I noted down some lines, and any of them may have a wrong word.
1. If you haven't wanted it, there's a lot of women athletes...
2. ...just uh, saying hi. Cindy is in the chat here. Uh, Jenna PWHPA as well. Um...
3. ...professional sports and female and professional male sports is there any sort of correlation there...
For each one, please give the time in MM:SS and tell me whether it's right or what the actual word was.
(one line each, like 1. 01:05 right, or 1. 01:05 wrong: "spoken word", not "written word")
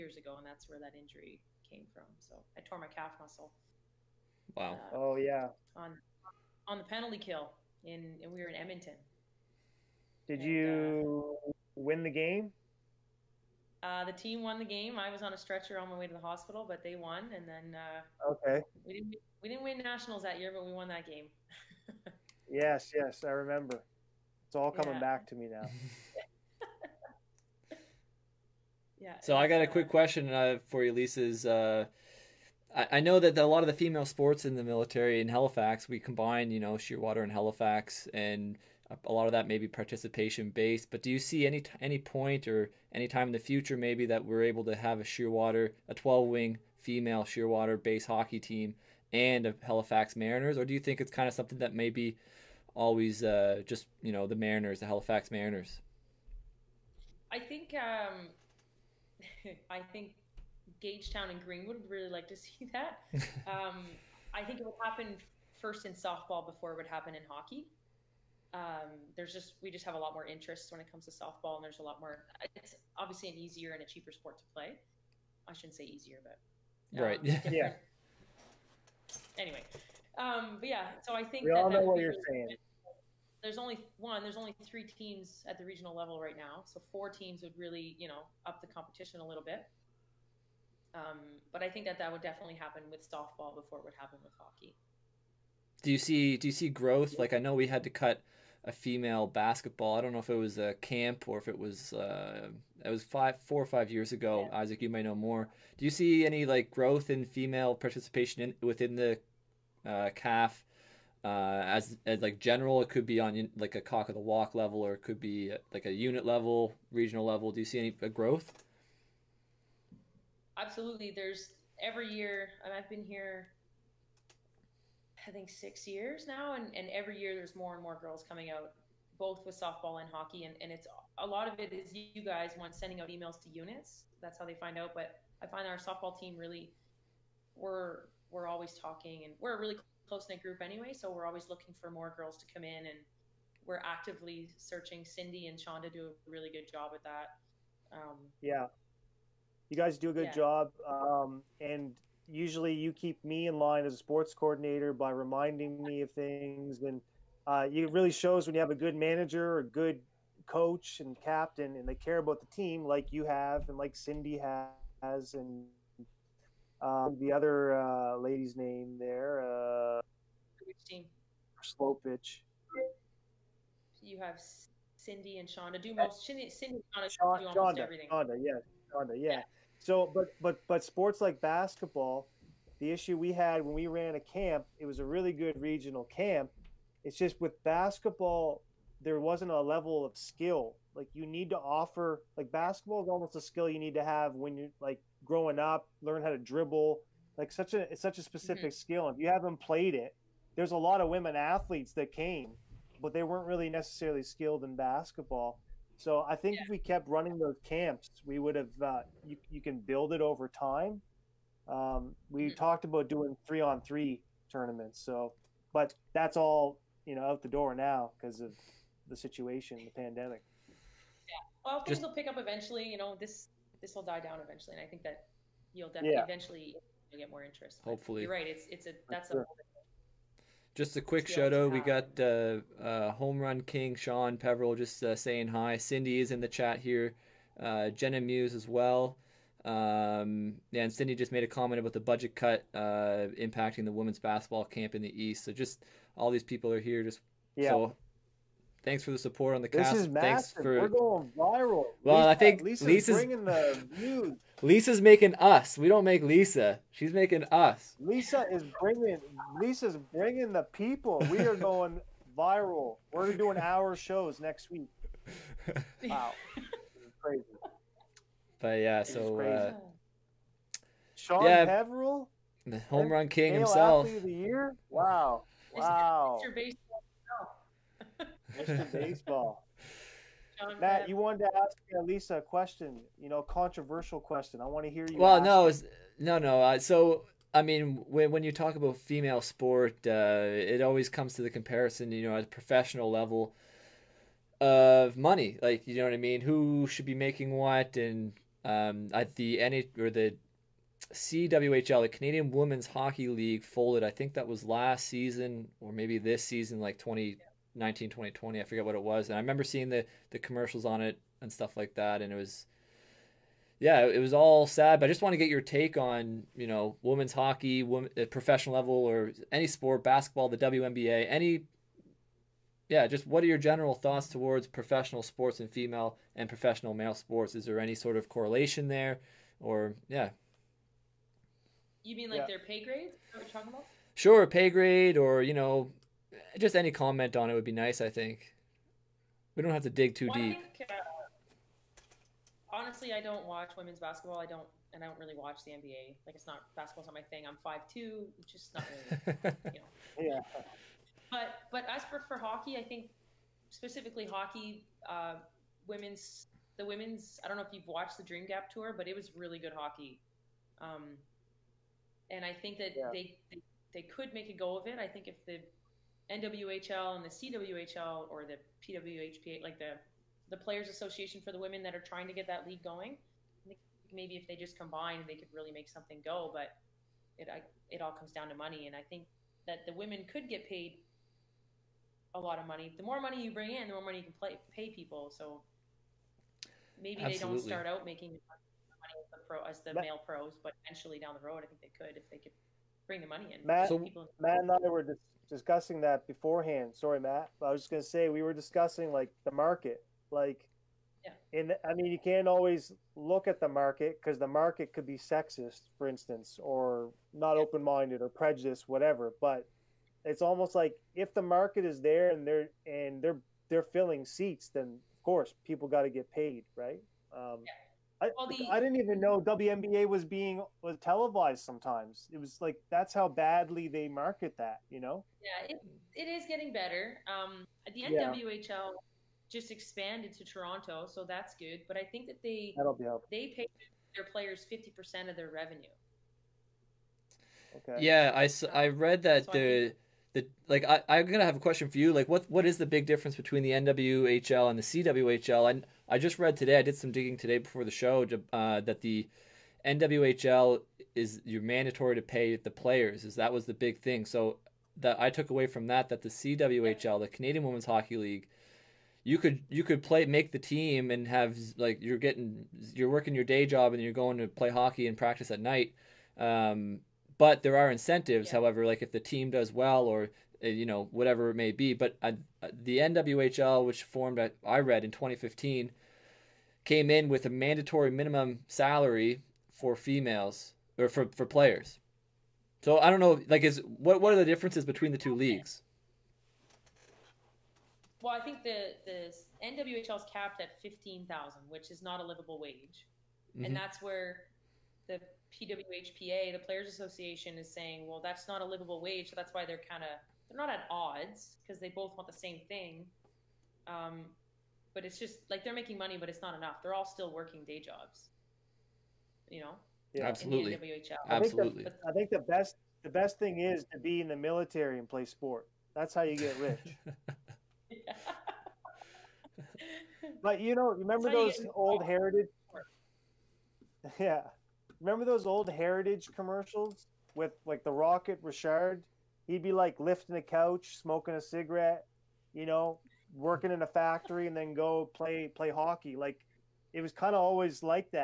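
1. 03:19 wrong: "played", not "wanted"
2. 03:54 wrong: "Muse", not "PWHPA"
3. 05:24 right.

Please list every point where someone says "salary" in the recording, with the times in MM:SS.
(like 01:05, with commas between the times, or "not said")
07:58.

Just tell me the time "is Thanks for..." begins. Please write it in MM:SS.
04:09.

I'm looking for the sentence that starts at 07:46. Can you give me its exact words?
Um, but there are incentives, yeah.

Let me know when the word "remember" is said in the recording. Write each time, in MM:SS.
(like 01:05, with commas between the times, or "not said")
00:23, 05:09, 08:40, 08:45.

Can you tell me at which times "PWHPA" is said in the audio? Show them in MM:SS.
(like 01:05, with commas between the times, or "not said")
06:08, 08:15.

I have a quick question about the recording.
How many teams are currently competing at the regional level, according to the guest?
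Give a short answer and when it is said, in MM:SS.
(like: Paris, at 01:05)
3, at 01:24.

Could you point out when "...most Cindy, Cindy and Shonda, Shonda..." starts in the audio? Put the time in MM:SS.
02:55.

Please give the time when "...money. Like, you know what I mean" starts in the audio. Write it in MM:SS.
04:55.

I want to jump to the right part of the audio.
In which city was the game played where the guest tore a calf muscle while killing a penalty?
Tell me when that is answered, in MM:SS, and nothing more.
00:08.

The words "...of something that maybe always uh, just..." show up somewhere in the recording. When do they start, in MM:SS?
00:51.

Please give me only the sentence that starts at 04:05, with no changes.
So just all these people are here.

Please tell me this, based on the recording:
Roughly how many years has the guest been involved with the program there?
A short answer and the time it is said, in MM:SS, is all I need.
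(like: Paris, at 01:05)
6, at 02:05.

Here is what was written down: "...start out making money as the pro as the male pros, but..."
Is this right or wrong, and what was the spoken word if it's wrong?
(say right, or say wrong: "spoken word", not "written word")
right.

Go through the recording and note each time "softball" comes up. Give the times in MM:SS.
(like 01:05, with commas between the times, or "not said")
01:05, 01:11, 01:33, 02:09, 02:15.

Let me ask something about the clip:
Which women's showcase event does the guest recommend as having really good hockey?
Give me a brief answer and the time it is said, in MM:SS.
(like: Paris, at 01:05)
Dream Gap tour, at 05:58.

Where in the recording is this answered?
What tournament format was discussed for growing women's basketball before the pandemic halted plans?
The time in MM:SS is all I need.
03:33.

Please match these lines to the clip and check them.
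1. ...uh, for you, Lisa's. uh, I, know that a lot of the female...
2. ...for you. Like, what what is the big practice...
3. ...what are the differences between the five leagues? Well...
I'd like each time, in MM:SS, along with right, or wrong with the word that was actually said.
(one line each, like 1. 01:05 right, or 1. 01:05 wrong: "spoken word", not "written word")
1. 00:30 right
2. 07:21 wrong: "difference", not "practice"
3. 08:04 wrong: "two", not "five".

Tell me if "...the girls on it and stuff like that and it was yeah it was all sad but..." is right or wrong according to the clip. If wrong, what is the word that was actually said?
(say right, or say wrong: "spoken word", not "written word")
wrong: "commercials", not "girls".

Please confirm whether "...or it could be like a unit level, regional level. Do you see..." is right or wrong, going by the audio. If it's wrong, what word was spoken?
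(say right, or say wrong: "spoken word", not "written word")
right.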